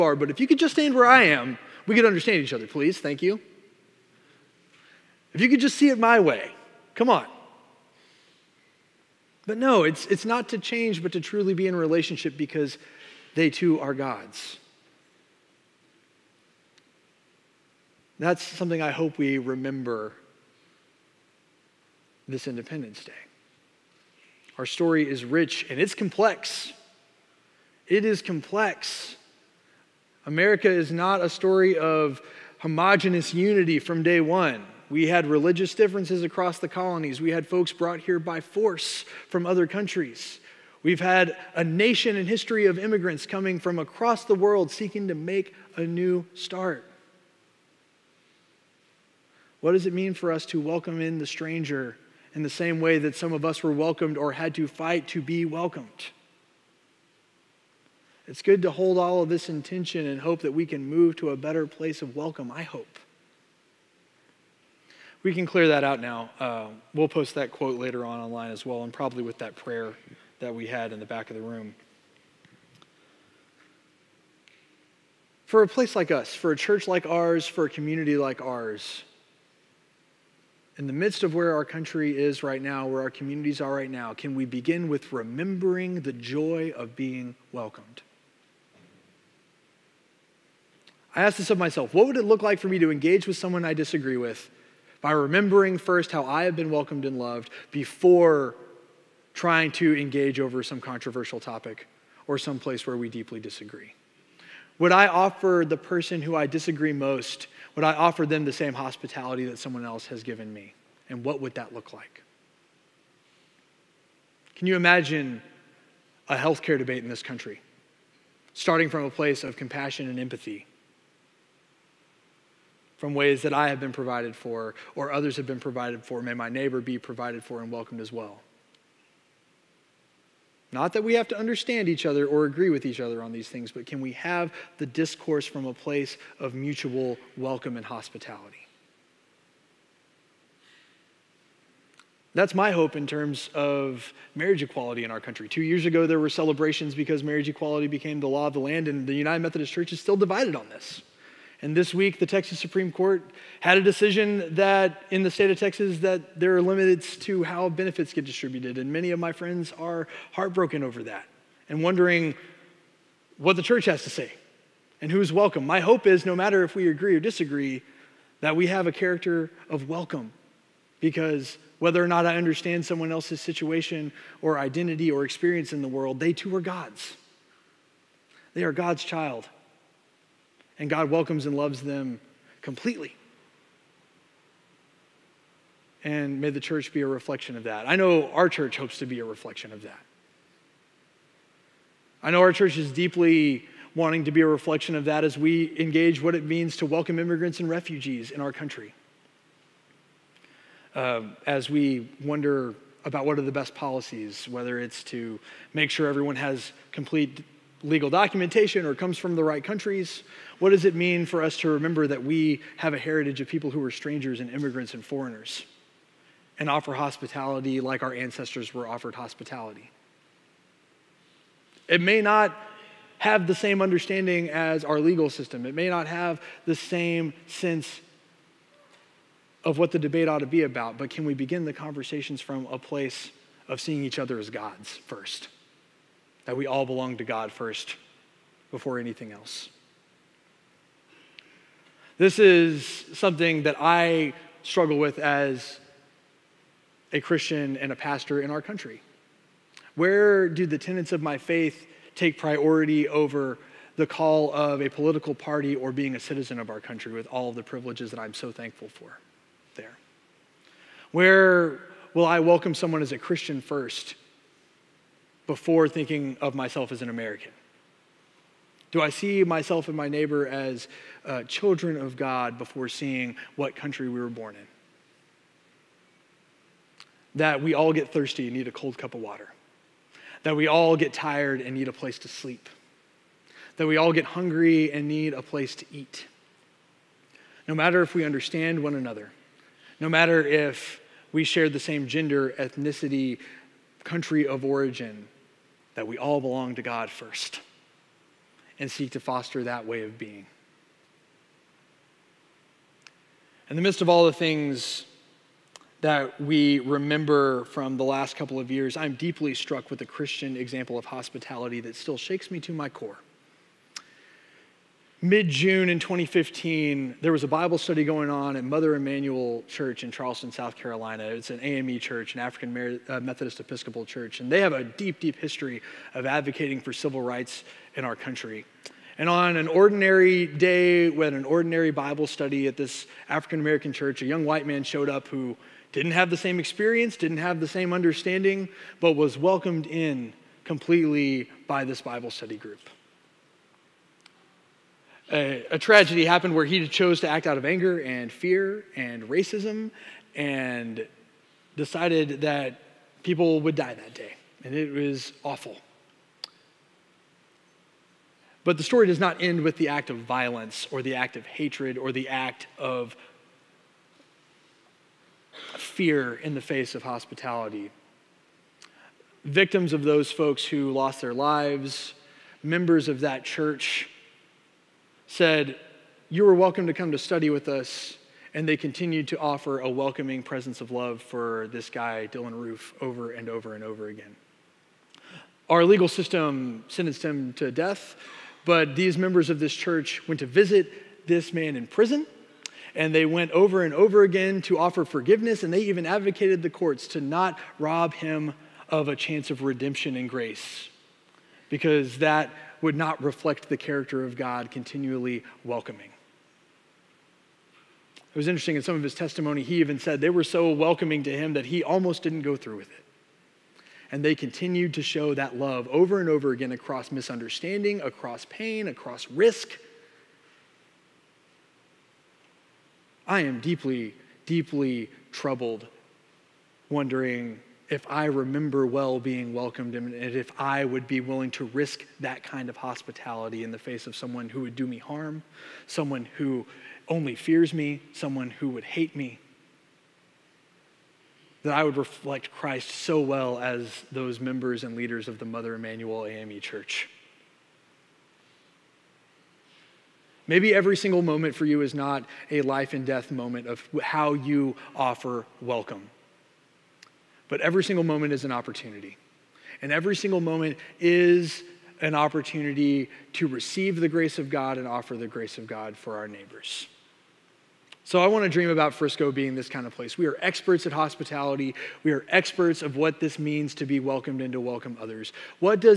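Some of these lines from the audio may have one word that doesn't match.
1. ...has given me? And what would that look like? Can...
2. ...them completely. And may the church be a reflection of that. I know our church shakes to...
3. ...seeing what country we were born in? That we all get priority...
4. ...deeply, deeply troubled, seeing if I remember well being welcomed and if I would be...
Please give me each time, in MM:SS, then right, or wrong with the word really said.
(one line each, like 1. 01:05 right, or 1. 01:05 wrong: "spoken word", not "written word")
1. 01:50 right
2. 03:01 wrong: "hopes", not "shakes"
3. 04:32 wrong: "thirsty", not "priority"
4. 07:03 wrong: "wondering", not "seeing".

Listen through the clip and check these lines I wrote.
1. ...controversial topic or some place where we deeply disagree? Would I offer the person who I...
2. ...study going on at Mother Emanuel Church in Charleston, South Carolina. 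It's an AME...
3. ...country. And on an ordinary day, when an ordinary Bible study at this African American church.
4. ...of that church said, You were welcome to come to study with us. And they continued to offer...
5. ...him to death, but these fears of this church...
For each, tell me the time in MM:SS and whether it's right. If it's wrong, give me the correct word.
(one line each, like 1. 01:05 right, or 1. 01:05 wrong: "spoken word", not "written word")
1. 01:40 right
2. 05:17 right
3. 05:28 right
4. 06:13 right
5. 06:27 wrong: "members", not "fears".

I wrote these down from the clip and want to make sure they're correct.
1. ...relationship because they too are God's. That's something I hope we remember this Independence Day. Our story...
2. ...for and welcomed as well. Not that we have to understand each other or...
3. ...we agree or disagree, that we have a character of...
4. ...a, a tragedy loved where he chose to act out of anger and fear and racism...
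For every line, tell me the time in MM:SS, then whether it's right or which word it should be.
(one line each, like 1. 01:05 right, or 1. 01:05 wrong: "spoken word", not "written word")
1. 00:11 right
2. 02:07 right
3. 02:46 right
4. 05:45 wrong: "happened", not "loved".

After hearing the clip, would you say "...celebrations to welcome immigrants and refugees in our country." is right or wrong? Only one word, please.
wrong.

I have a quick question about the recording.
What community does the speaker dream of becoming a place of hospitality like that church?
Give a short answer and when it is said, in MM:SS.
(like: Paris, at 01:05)
Frisco, at 07:48.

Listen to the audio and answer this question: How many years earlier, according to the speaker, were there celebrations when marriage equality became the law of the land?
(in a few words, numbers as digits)
2.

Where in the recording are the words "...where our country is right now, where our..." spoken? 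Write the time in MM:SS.
01:21.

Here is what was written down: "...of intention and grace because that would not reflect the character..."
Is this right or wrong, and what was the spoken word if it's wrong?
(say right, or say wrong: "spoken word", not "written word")
wrong: "redemption", not "intention".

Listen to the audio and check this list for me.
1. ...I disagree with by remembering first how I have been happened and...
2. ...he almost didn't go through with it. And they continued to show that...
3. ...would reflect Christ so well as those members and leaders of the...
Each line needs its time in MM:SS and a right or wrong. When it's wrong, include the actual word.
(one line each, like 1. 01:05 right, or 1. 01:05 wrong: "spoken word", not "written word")
1. 01:33 wrong: "welcomed", not "happened"
2. 06:51 right
3. 07:21 right.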